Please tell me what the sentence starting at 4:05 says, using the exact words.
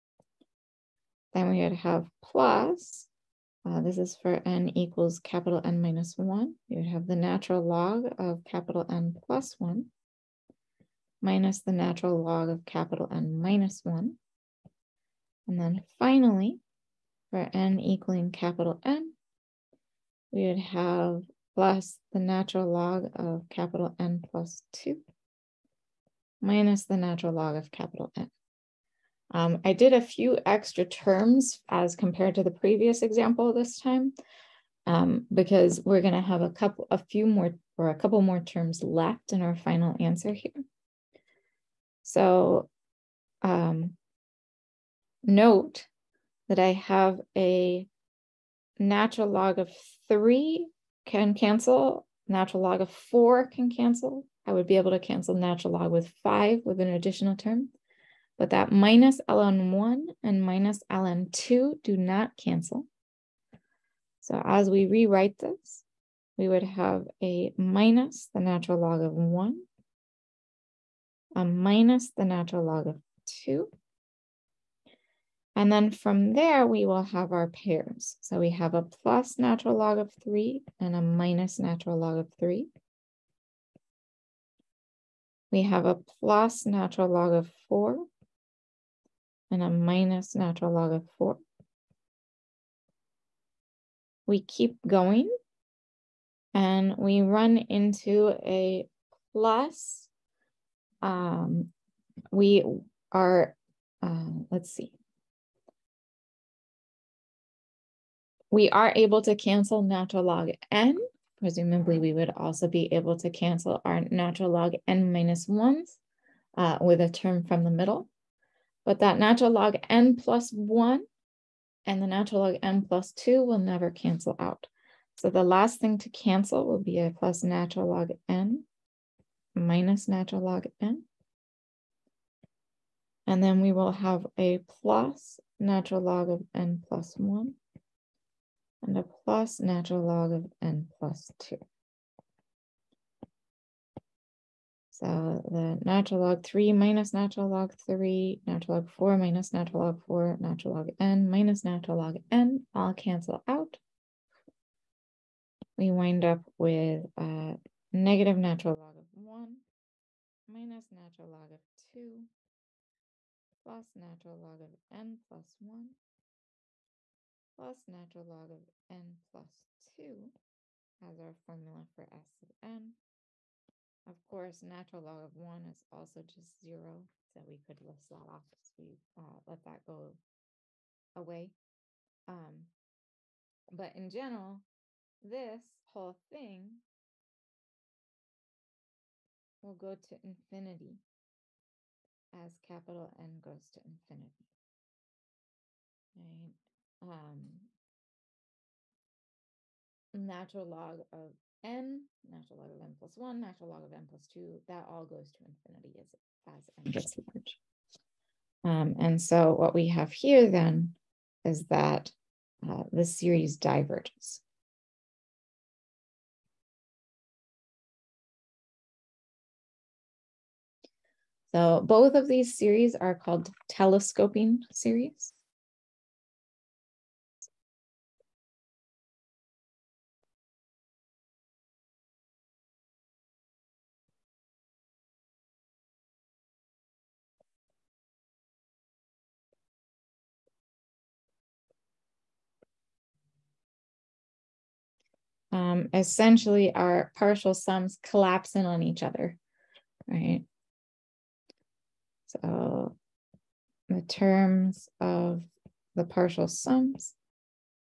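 um, essentially our partial sums collapse in on each other, right?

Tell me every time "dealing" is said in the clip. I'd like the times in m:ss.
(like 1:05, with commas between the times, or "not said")
not said.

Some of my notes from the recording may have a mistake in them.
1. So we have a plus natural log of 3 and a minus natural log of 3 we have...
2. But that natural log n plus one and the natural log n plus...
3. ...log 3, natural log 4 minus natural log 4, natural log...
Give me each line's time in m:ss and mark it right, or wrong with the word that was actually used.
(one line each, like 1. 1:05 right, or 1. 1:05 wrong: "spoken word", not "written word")
1. 1:18 right
2. 1:58 right
3. 2:27 right.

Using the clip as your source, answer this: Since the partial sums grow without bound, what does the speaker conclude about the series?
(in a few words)
the series diverges.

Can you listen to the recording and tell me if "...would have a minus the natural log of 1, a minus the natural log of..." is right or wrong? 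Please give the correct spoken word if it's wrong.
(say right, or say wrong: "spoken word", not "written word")
right.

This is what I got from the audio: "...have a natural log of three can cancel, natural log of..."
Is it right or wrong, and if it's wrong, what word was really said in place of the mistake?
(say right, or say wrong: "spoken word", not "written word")
right.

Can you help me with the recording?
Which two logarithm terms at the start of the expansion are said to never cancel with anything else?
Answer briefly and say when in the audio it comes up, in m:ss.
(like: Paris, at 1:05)
minus ln1 and minus ln2, at 0:58.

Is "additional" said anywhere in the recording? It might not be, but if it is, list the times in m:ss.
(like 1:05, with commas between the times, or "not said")
0:56.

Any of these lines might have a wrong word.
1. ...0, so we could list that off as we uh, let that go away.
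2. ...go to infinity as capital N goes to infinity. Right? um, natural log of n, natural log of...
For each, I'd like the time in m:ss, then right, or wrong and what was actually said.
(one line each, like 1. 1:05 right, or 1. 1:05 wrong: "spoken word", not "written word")
1. 2:56 right
2. 3:09 right.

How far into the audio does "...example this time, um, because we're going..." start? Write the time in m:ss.
0:33.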